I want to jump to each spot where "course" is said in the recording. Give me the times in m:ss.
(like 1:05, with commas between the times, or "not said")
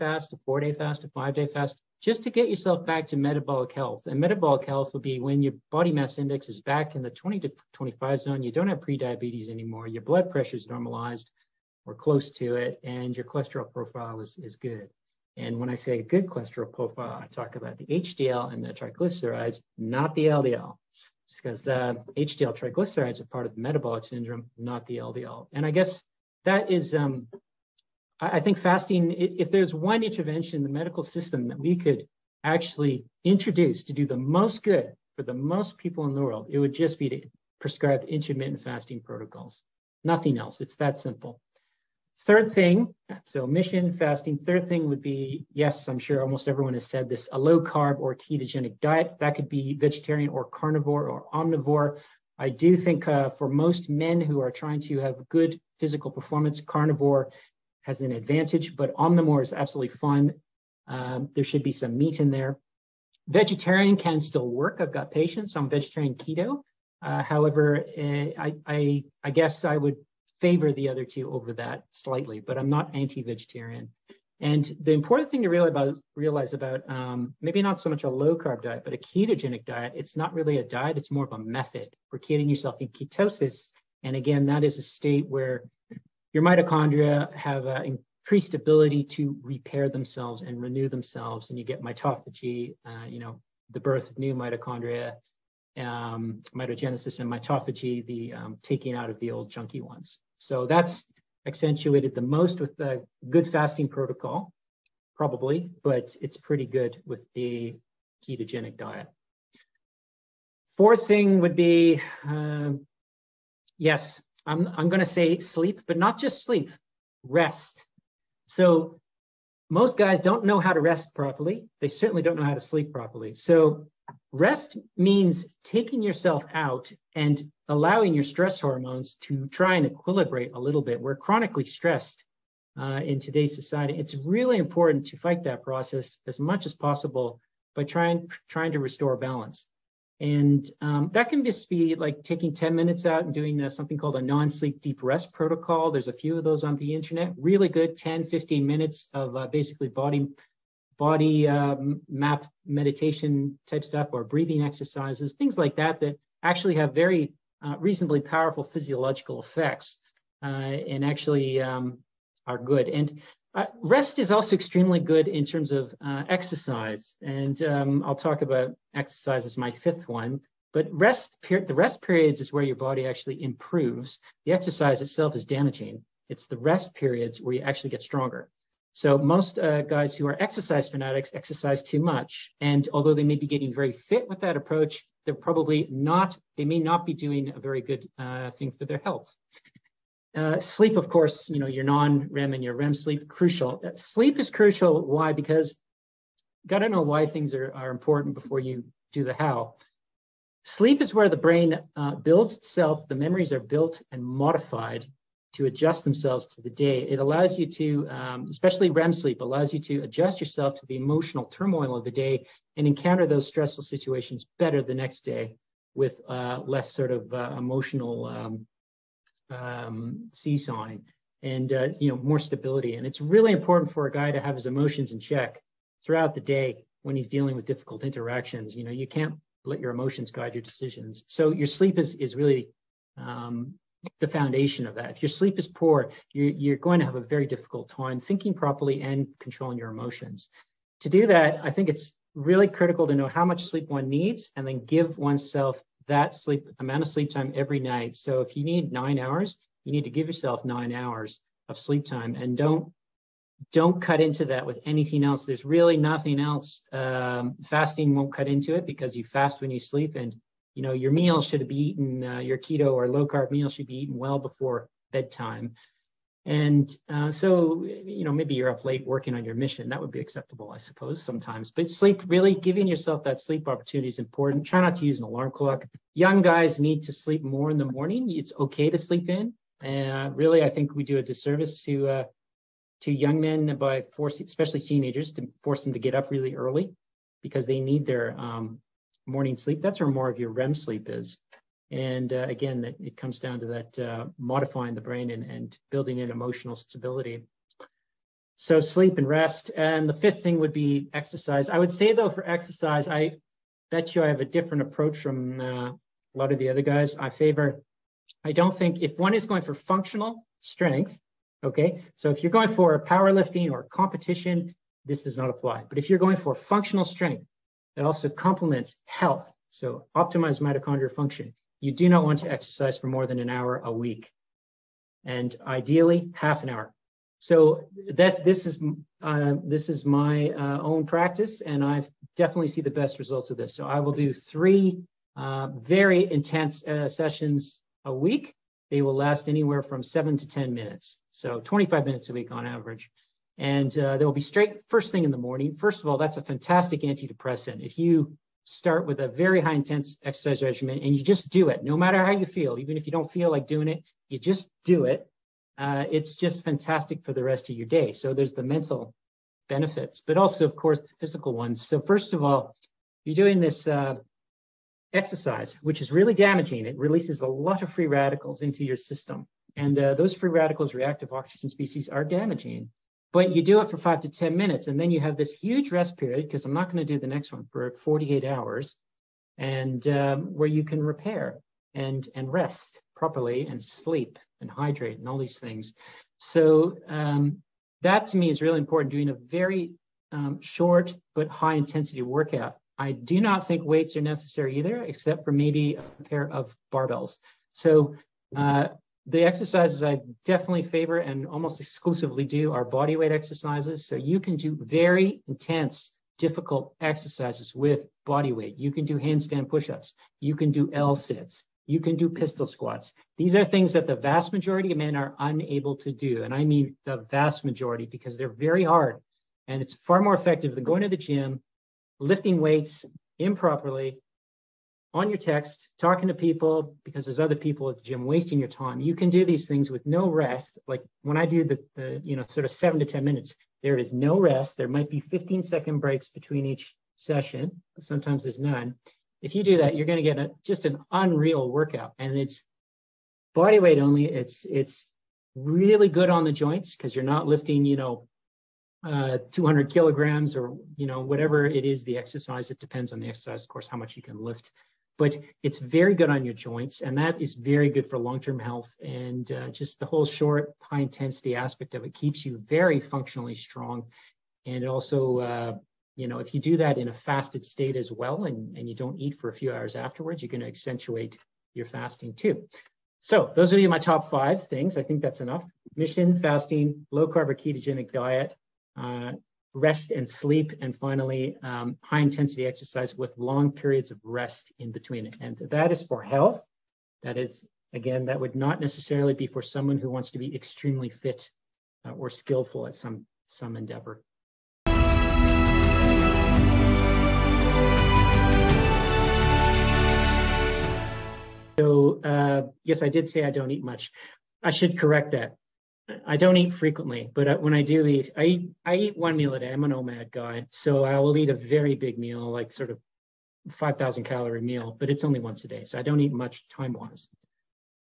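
3:11, 6:00, 7:33.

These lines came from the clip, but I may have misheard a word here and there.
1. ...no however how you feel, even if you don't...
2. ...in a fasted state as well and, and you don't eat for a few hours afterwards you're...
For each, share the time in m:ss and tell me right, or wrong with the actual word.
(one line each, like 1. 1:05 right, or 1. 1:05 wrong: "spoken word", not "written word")
1. 5:51 wrong: "matter", not "however"
2. 7:46 right.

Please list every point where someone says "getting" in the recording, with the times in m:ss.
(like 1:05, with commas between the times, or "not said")
1:22, 3:03.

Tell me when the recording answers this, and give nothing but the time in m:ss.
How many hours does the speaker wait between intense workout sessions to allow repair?
6:17.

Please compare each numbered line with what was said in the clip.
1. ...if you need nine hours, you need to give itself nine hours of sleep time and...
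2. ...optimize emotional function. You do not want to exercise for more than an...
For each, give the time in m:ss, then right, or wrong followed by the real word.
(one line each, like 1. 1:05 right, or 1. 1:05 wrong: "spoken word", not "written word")
1. 4:08 wrong: "yourself", not "itself"
2. 5:20 wrong: "mitochondrial", not "emotional".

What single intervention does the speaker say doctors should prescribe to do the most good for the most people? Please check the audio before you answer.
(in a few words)
intermittent fasting protocols.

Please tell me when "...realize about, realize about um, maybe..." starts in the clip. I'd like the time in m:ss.
1:15.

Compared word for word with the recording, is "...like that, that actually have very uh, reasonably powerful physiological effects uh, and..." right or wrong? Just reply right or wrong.
right.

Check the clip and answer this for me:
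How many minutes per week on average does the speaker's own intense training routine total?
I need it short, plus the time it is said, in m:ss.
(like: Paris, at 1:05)
25 minutes, at 5:41.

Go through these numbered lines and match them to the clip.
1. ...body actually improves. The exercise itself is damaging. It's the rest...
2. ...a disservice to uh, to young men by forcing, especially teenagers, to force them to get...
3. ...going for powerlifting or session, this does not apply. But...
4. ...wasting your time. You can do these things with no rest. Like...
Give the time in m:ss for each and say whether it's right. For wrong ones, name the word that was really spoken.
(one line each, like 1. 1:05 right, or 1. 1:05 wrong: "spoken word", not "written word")
1. 2:52 right
2. 4:41 right
3. 5:12 wrong: "competition", not "session"
4. 7:08 right.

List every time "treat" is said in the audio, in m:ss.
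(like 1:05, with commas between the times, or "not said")
not said.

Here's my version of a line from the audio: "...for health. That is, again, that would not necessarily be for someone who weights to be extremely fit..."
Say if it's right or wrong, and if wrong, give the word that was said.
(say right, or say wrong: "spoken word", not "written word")
wrong: "wants", not "weights".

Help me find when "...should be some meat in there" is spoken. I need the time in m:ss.
1:01.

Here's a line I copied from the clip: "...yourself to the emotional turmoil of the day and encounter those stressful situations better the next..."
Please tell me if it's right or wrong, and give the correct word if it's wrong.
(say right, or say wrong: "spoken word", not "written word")
right.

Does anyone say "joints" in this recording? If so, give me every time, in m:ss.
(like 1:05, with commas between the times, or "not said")
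7:26, 7:36.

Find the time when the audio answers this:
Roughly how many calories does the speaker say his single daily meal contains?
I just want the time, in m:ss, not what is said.
8:33.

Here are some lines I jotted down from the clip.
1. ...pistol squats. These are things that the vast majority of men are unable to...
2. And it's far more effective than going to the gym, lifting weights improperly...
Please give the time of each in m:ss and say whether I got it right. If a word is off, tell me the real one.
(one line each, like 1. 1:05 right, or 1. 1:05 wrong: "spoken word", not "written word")
1. 6:52 right
2. 6:59 right.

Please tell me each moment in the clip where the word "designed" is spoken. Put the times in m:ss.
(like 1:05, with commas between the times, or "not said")
not said.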